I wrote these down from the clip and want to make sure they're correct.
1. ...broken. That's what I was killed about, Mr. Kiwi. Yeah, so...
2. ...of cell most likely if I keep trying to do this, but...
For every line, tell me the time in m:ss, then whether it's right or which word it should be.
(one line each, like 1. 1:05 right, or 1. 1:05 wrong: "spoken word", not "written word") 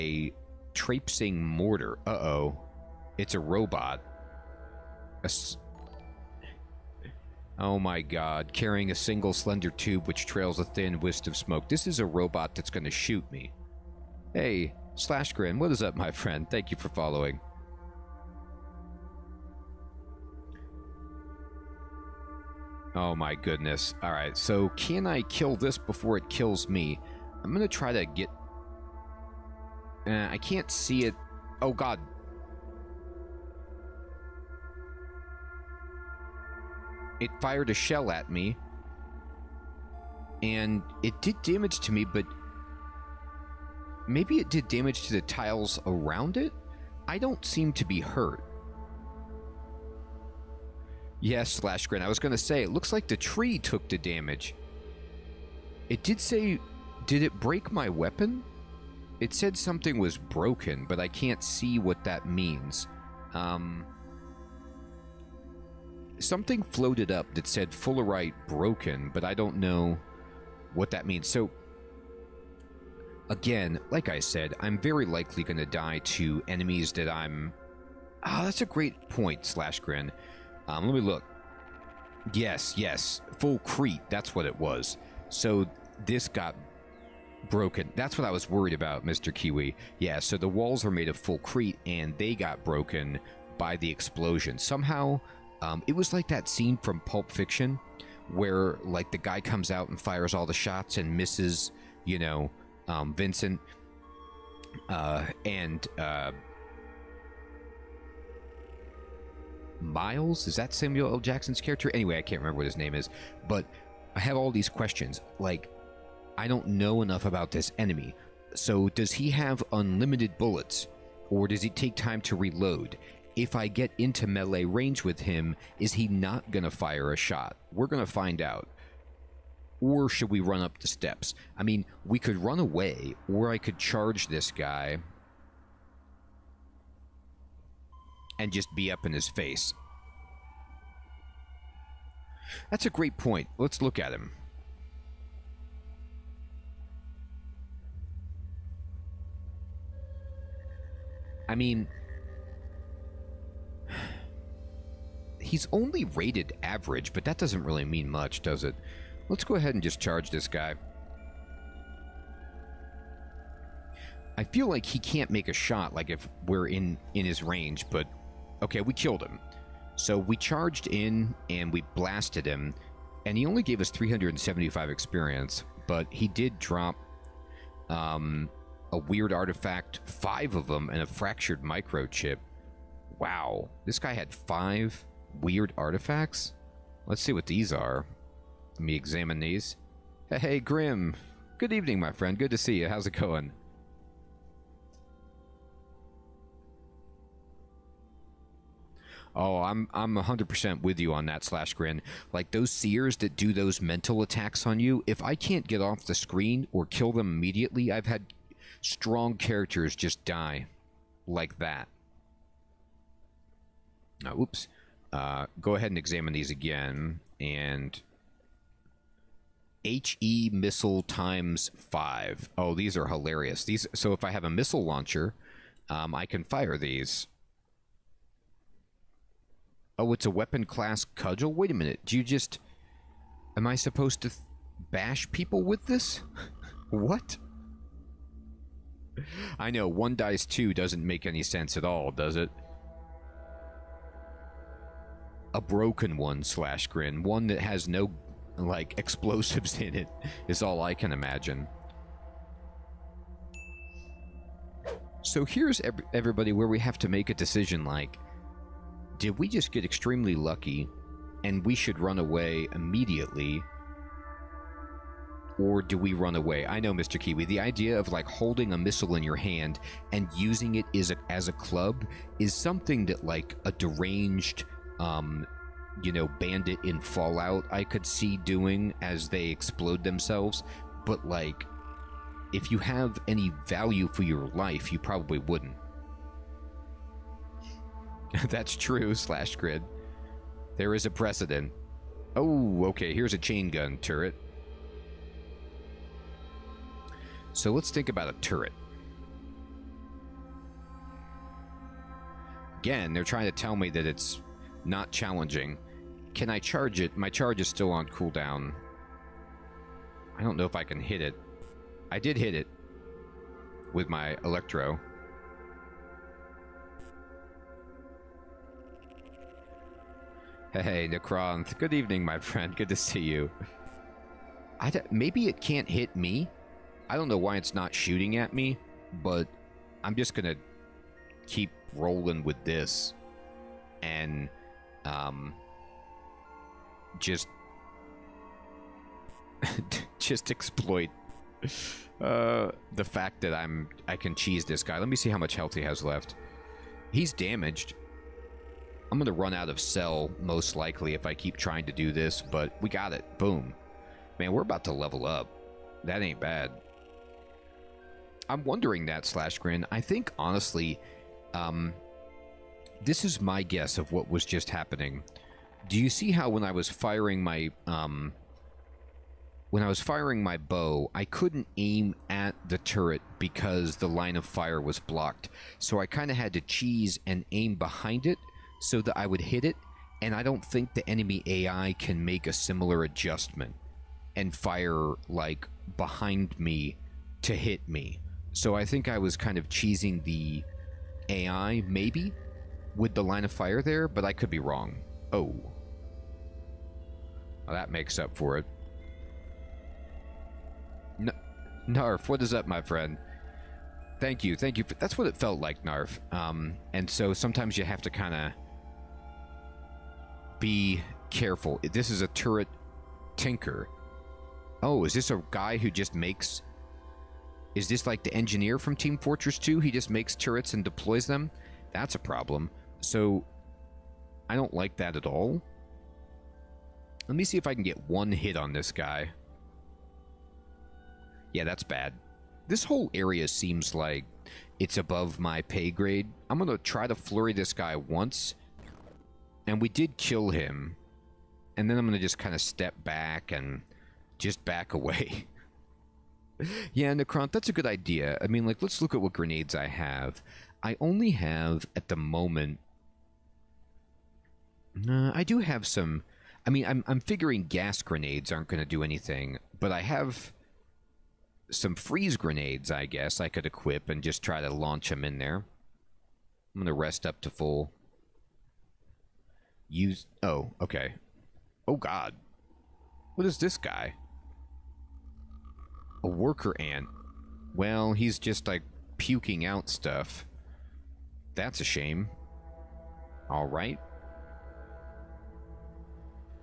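1. 1:27 wrong: "worried", not "killed"
2. 5:49 right.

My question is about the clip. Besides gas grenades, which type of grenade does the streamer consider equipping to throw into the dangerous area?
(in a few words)
freeze grenades.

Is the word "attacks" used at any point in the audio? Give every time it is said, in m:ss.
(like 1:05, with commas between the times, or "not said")
3:24.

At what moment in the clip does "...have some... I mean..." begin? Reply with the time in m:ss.
7:35.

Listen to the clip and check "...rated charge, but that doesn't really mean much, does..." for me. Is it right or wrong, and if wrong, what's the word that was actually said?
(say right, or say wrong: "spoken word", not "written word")
wrong: "average", not "charge".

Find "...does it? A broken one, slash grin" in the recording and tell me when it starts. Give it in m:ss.
4:02.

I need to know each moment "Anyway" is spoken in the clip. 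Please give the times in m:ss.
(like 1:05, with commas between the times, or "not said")
1:51.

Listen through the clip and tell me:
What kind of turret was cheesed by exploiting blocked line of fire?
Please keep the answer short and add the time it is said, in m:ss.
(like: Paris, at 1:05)
chain gun turret, at 4:53.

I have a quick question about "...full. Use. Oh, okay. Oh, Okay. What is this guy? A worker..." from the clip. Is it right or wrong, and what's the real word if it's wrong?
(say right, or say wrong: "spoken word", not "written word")
wrong: "God", not "Okay".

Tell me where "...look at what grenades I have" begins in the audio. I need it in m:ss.
7:29.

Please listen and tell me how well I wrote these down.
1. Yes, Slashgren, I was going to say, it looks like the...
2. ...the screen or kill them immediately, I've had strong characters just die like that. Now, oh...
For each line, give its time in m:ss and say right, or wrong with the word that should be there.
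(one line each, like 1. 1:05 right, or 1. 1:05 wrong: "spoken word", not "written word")
1. 0:51 right
2. 3:26 right.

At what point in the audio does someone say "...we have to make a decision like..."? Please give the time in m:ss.
4:16.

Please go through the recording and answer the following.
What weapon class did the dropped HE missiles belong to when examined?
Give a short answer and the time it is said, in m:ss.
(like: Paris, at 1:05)
cudgel, at 3:51.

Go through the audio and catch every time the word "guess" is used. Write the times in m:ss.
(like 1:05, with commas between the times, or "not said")
6:03, 7:43.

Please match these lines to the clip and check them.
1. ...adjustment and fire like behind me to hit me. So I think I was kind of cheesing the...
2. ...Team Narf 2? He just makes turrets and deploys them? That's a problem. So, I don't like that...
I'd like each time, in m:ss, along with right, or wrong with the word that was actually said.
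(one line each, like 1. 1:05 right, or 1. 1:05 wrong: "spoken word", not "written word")
1. 6:23 right
2. 6:58 wrong: "Fortress", not "Narf".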